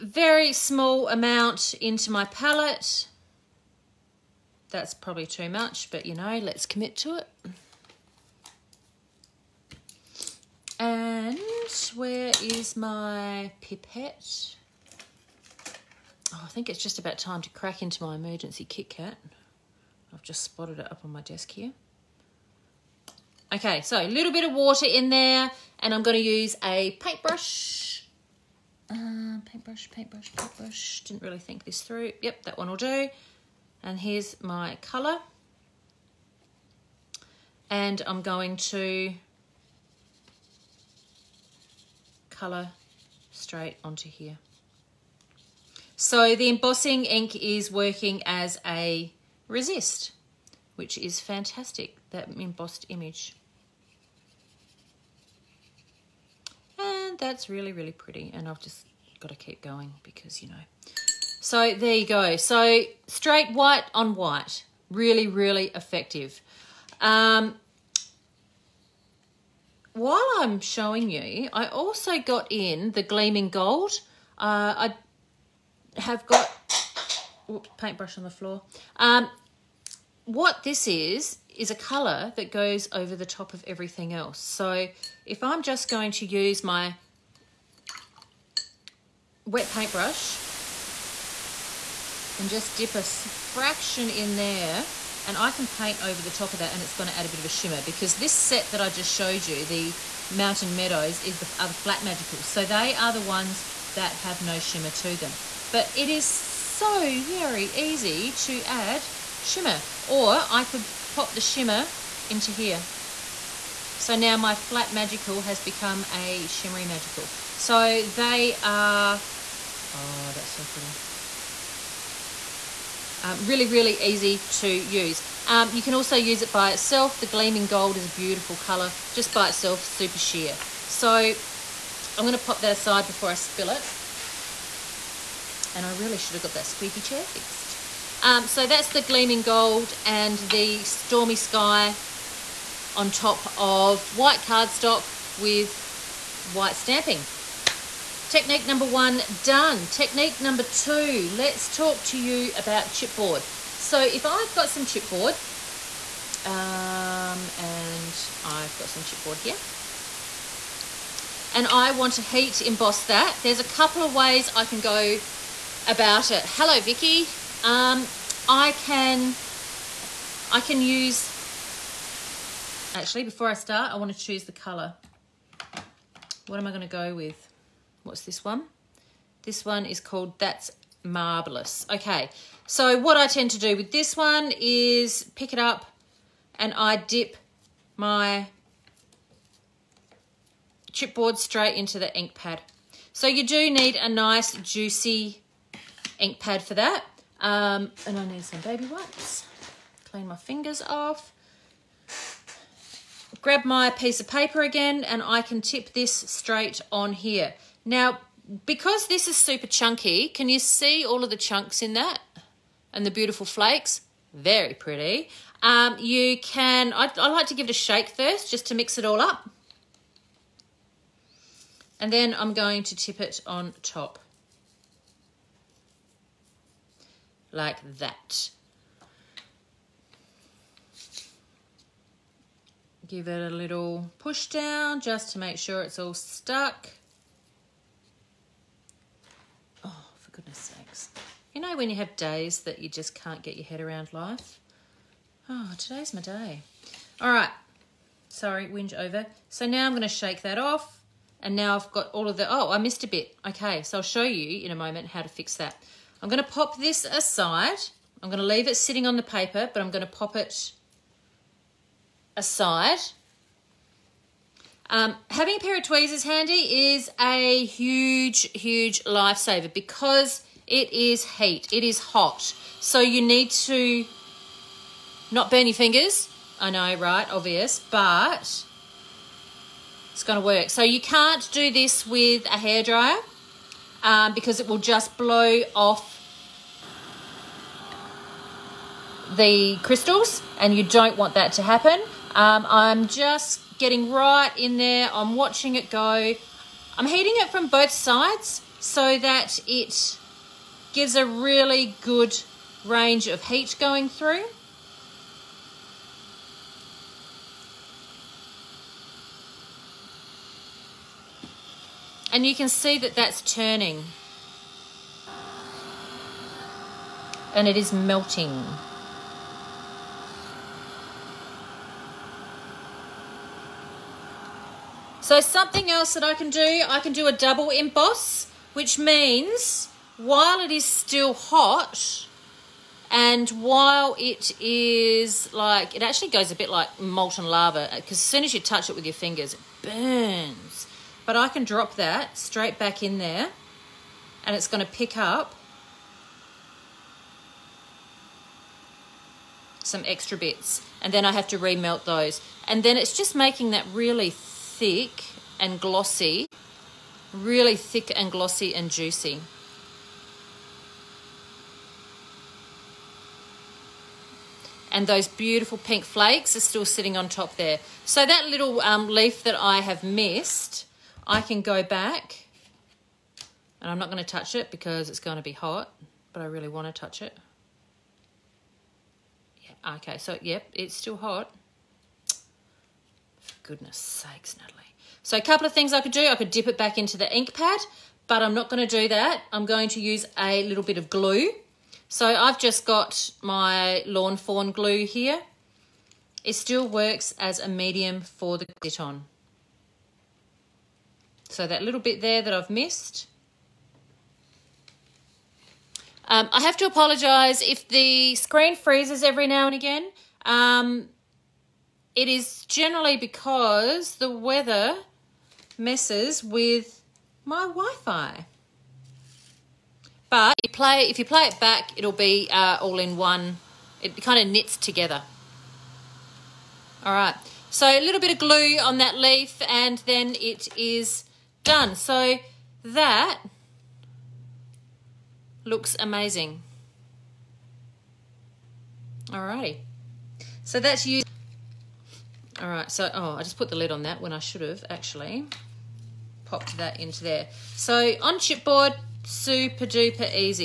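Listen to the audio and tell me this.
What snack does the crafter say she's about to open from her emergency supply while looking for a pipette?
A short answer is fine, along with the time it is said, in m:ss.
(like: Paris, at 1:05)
Kit Kat, at 0:18.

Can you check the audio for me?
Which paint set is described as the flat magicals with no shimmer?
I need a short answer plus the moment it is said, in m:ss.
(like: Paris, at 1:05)
Mountain Meadows, at 1:40.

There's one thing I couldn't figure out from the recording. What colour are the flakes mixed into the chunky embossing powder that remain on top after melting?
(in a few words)
pink.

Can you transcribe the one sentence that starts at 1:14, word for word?
Uh, I have got, whoops, paintbrush on the floor.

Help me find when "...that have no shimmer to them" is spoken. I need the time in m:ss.
1:43.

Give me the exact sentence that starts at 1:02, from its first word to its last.
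So straight white on white, really, really effective.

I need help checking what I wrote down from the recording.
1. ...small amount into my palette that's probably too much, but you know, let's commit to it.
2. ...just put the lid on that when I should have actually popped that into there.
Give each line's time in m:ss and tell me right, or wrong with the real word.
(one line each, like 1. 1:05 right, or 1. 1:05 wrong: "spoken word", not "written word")
1. 0:00 right
2. 7:23 right.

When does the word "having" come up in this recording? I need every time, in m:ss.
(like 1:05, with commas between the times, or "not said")
4:25.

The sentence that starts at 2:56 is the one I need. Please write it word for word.
What am I going to go with?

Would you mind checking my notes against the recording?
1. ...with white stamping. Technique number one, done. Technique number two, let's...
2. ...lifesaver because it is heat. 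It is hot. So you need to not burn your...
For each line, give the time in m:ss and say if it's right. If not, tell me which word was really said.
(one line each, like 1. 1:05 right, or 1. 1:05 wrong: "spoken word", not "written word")
1. 2:25 right
2. 4:29 right.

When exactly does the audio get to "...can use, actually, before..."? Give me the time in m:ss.
2:50.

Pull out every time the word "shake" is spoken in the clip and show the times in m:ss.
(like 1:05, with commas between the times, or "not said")
3:37, 4:10.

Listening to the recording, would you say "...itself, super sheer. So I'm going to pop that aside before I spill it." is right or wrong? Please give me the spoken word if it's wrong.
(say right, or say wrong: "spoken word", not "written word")
right.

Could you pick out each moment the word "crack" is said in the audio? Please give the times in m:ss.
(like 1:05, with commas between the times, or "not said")
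0:17.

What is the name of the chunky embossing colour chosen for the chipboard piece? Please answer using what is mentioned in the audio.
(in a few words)
That's Marvelous.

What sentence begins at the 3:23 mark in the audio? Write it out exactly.
Grab my piece of paper again and I can tip this straight on here.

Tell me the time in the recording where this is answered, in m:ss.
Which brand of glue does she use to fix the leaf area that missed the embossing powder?
6:34.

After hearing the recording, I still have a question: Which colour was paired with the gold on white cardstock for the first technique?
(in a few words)
stormy sky.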